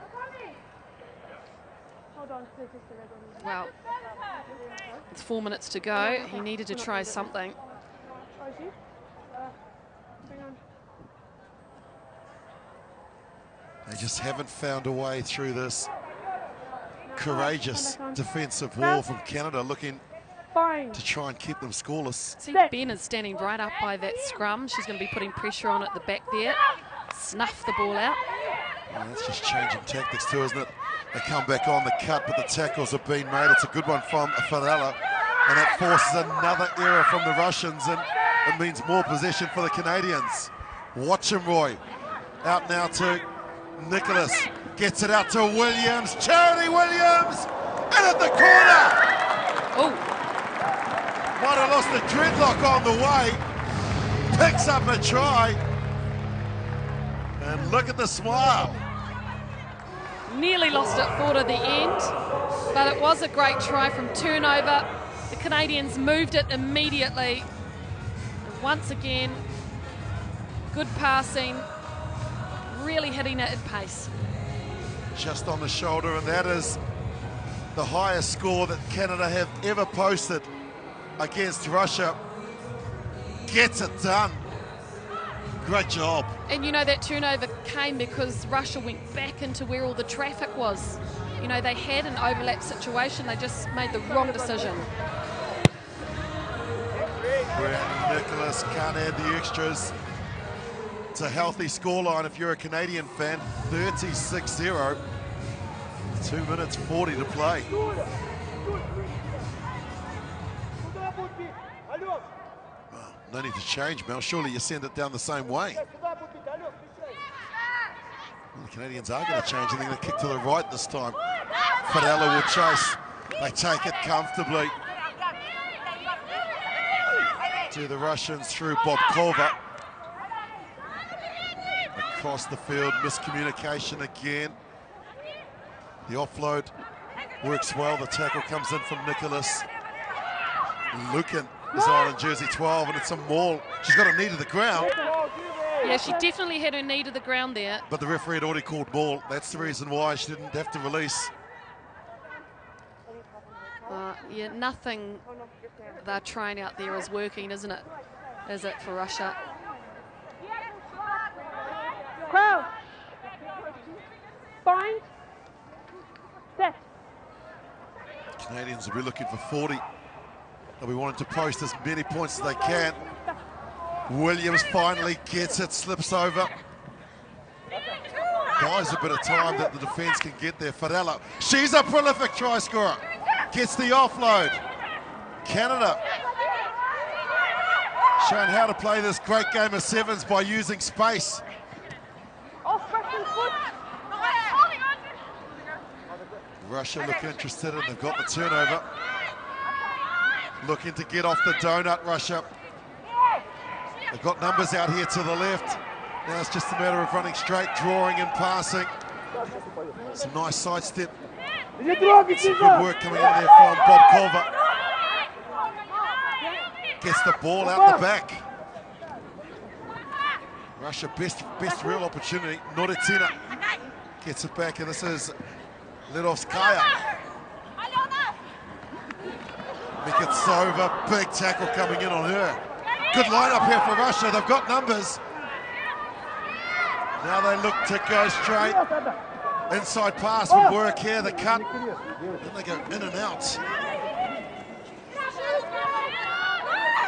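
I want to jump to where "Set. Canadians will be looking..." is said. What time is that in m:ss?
2:46.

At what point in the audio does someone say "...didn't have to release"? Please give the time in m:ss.
2:30.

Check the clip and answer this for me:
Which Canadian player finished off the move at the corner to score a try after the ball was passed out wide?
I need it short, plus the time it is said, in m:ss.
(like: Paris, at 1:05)
Charity Williams, at 0:46.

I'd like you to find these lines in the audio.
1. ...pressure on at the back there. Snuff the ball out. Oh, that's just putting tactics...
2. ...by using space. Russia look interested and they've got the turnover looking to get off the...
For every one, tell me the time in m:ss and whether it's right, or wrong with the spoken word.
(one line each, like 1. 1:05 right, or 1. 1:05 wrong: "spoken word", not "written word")
1. 0:25 wrong: "changing", not "putting"
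2. 3:10 right.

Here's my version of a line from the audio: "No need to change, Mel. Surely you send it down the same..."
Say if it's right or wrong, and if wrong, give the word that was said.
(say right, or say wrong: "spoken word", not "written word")
right.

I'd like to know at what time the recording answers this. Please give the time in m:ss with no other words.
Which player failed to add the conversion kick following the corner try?
1:37.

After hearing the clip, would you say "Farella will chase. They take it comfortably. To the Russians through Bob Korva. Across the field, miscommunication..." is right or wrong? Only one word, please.
right.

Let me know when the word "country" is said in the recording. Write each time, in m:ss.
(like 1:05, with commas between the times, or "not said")
not said.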